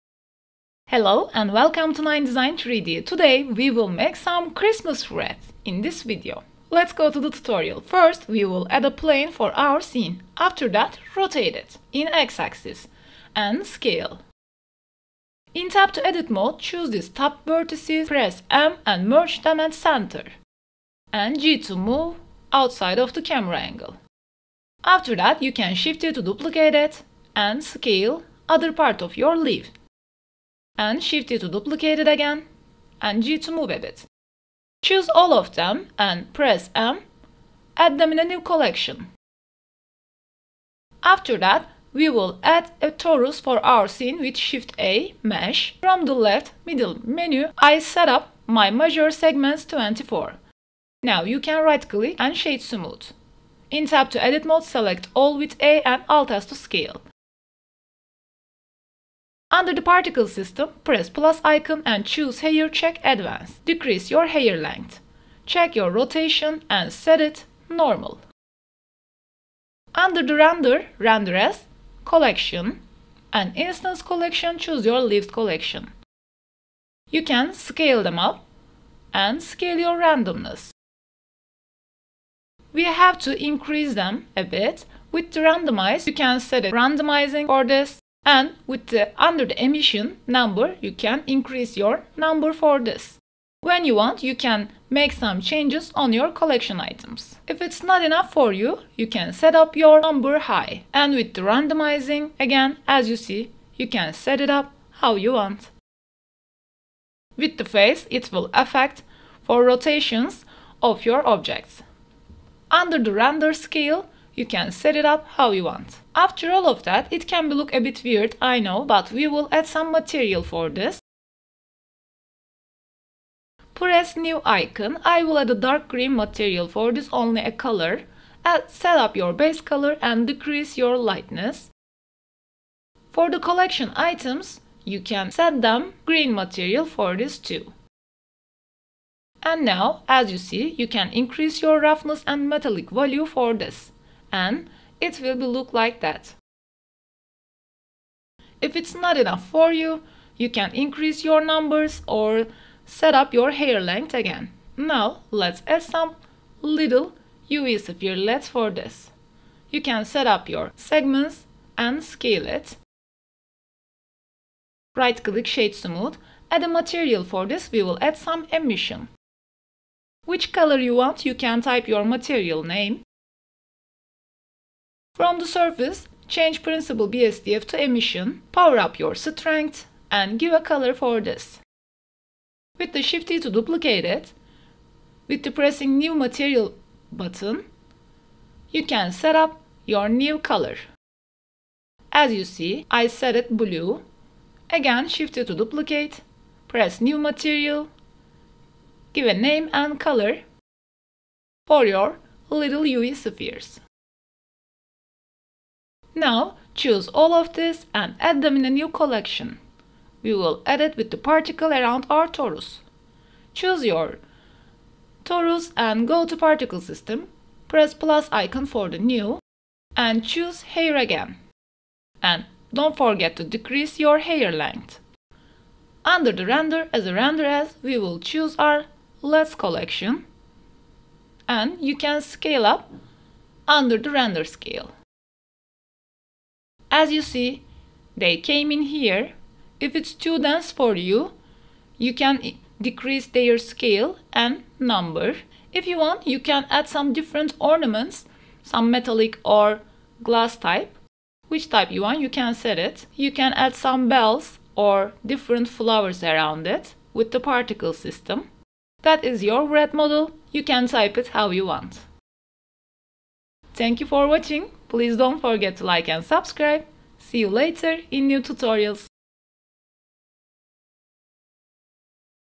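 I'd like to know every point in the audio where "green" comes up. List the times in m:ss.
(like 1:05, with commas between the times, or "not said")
2:05, 2:16.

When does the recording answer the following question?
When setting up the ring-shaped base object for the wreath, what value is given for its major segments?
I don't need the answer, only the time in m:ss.
0:48.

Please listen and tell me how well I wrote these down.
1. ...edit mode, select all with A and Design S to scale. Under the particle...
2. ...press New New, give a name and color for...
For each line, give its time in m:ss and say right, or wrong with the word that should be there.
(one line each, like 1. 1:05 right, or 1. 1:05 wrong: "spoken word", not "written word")
1. 0:54 wrong: "Alt", not "Design"
2. 3:16 wrong: "Material", not "New".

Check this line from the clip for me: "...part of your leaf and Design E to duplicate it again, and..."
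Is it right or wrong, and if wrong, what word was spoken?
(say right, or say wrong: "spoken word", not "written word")
wrong: "Shift", not "Design".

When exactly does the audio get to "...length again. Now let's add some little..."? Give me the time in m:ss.
2:33.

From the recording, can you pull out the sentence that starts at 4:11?
Which type you want, you can set it.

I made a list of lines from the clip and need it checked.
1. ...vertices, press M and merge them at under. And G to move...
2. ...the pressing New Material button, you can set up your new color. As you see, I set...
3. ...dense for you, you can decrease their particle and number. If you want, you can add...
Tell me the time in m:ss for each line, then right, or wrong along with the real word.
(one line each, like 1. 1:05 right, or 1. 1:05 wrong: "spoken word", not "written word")
1. 0:17 wrong: "center", not "under"
2. 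3:05 right
3. 4:00 wrong: "scale", not "particle".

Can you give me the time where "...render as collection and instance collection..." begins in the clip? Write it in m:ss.
1:10.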